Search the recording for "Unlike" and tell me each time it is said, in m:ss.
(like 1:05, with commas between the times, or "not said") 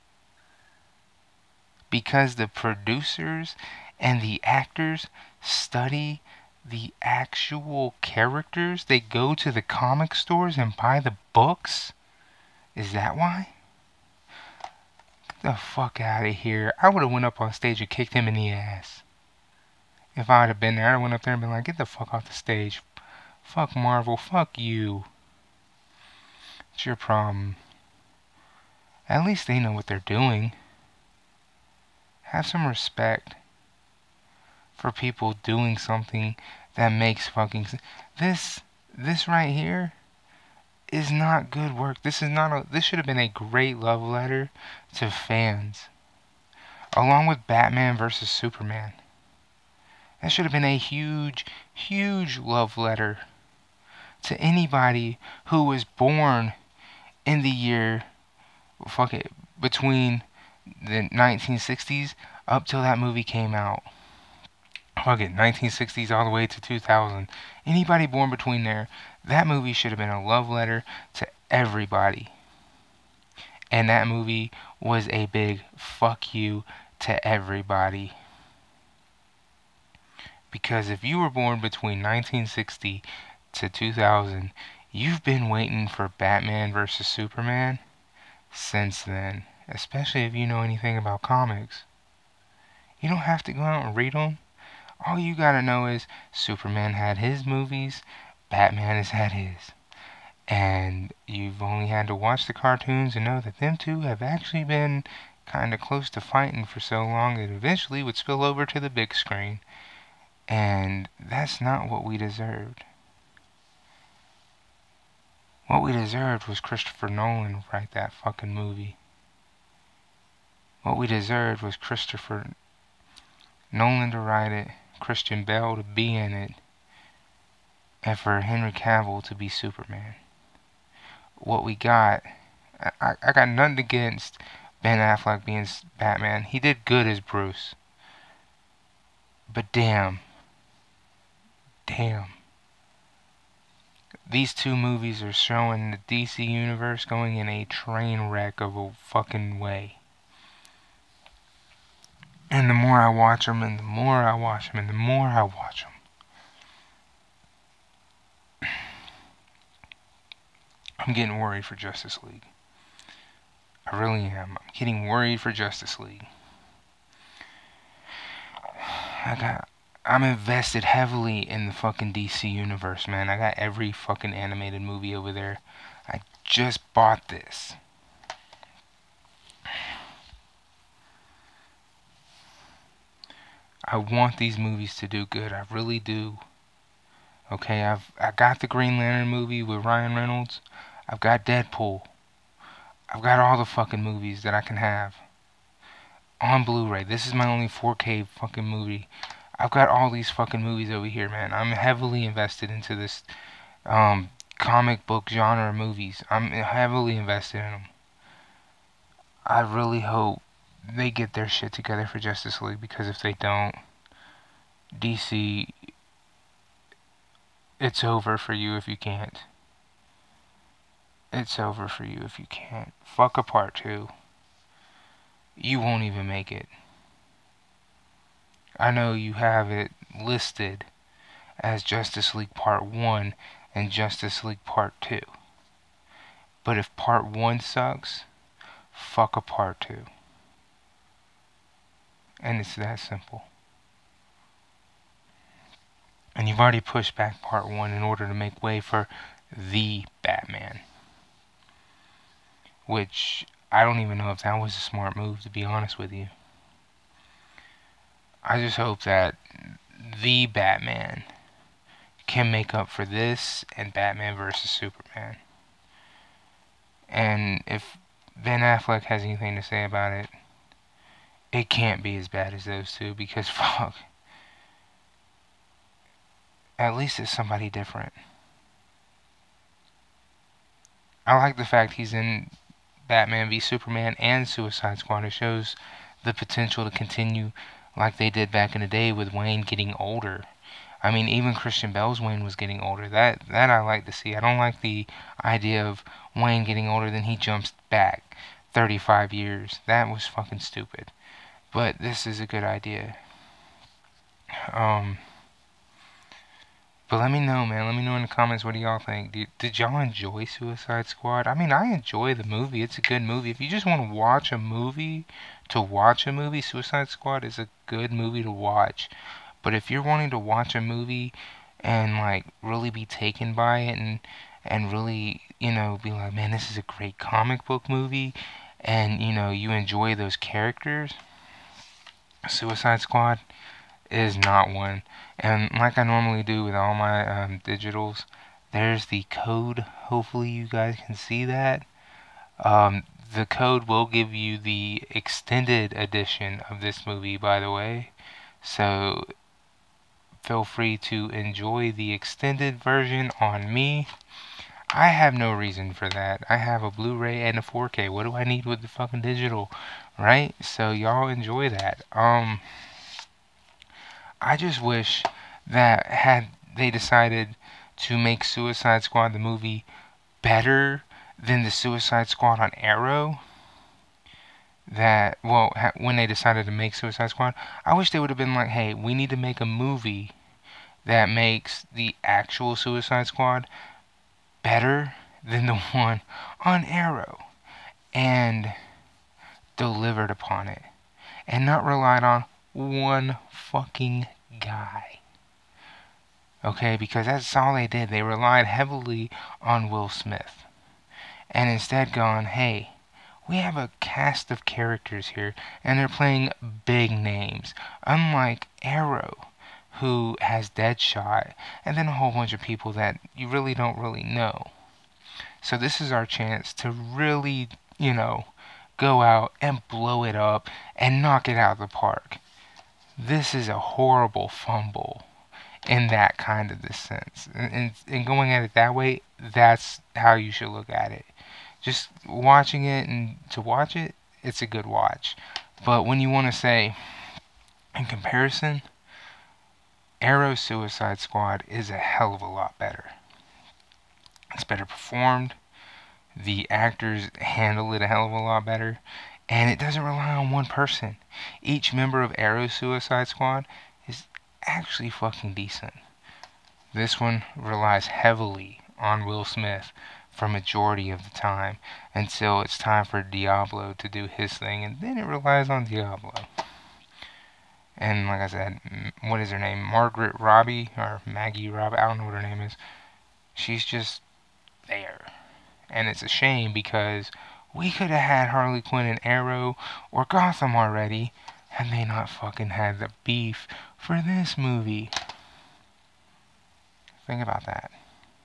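6:48.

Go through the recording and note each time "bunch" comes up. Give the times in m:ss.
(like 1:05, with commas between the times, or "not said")
6:52.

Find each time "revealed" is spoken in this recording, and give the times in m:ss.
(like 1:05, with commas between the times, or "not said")
not said.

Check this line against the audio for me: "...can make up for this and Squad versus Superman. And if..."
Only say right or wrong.
wrong.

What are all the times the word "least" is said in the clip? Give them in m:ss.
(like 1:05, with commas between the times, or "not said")
0:29, 4:36.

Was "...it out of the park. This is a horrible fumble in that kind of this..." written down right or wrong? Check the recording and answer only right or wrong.
right.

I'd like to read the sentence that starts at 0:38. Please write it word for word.
This, this right here is not good work.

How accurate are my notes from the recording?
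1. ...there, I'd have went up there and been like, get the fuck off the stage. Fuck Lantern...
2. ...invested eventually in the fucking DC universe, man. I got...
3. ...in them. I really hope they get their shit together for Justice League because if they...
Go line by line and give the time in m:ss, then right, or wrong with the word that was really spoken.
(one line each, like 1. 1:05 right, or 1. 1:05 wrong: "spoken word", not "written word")
1. 0:20 wrong: "Marvel", not "Lantern"
2. 2:50 wrong: "heavily", not "eventually"
3. 3:27 right.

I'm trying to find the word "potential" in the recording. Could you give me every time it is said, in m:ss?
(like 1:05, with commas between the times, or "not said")
4:46.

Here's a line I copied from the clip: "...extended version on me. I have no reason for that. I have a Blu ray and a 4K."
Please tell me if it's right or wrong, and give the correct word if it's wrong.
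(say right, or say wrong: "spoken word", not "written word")
right.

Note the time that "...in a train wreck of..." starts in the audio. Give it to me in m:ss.
2:27.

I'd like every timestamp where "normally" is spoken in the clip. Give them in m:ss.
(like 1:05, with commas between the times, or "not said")
5:36.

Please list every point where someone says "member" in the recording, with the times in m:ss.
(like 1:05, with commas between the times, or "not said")
7:31.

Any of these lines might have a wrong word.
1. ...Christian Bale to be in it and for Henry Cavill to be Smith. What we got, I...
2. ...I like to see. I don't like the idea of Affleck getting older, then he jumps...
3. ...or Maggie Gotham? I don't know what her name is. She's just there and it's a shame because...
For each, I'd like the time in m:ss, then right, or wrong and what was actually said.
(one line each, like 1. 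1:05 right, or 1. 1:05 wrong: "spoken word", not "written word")
1. 2:05 wrong: "Superman", not "Smith"
2. 4:53 wrong: "Wayne", not "Affleck"
3. 7:50 wrong: "Robbie", not "Gotham".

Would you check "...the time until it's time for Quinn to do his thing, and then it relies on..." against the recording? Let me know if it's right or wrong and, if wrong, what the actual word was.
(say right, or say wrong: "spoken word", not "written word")
wrong: "Diablo", not "Quinn".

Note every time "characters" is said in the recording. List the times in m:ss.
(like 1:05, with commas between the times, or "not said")
0:08, 5:30, 6:44.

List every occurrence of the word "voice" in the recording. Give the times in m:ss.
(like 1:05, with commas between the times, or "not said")
not said.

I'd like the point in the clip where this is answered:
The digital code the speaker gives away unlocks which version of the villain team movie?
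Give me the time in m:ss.
5:45.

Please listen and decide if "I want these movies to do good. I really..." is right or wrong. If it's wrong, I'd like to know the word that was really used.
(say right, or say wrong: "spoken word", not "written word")
right.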